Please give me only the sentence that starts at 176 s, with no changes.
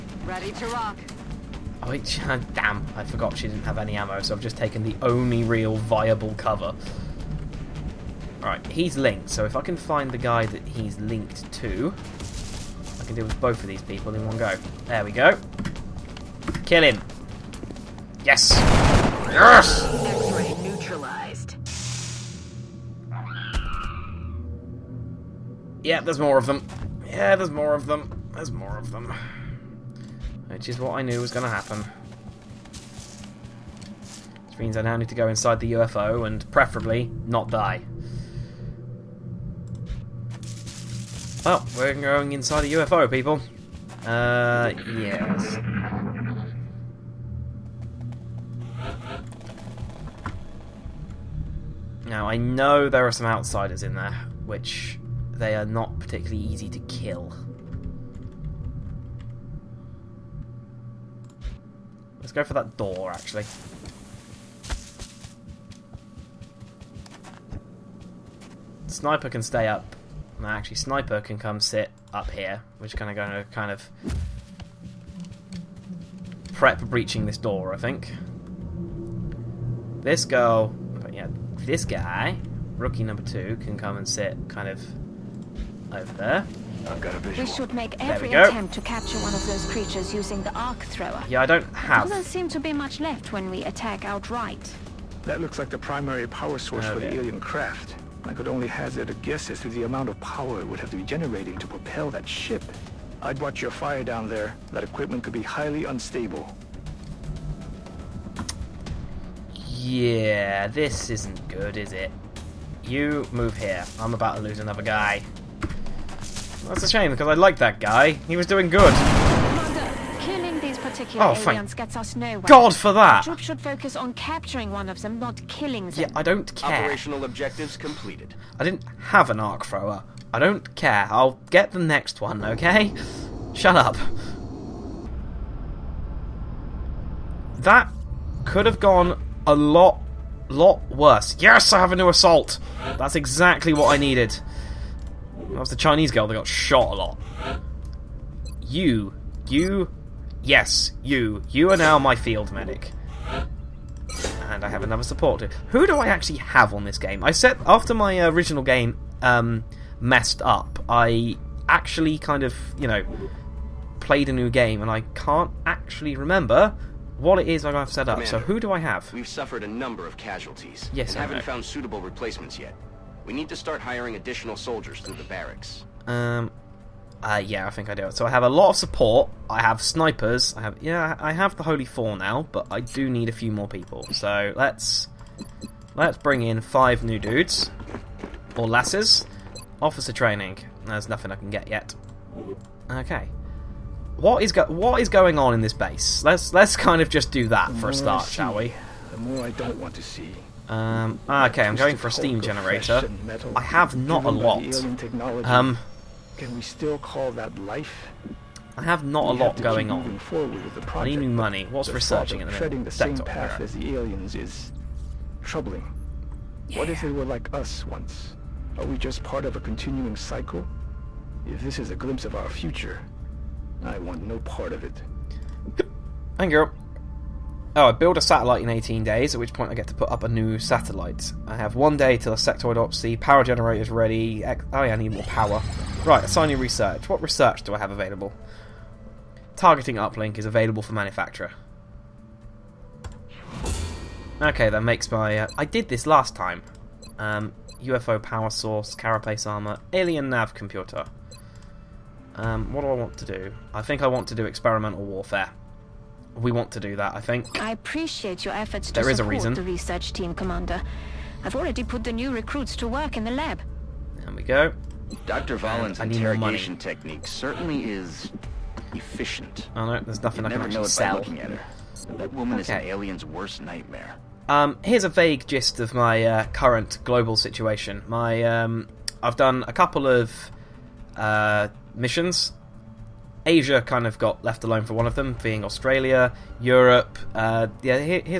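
Um, uh, yeah, I think I do So I have a lot of support.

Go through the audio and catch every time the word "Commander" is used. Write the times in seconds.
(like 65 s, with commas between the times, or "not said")
168 s, 260 s.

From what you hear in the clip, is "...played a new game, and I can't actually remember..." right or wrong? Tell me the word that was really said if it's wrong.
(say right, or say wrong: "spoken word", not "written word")
right.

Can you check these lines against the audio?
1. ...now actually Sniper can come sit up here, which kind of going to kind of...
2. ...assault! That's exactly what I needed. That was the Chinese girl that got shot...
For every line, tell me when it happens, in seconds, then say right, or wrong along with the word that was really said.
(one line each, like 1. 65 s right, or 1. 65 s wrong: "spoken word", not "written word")
1. 70 s right
2. 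142 s right.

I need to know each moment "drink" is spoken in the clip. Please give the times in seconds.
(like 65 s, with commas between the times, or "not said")
not said.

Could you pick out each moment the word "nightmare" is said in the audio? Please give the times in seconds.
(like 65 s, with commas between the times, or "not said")
273 s.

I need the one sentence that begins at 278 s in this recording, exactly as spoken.
My um, I've done a couple of uh, missions.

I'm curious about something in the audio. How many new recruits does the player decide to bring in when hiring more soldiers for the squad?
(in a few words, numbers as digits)
5.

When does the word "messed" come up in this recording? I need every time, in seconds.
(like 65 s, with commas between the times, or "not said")
159 s.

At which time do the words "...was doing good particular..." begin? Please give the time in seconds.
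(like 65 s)
118 s.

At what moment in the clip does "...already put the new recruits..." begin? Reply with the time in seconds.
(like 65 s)
261 s.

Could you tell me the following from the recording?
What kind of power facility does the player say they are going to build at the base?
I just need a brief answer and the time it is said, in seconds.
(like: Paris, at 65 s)
Steam generator, at 202 s.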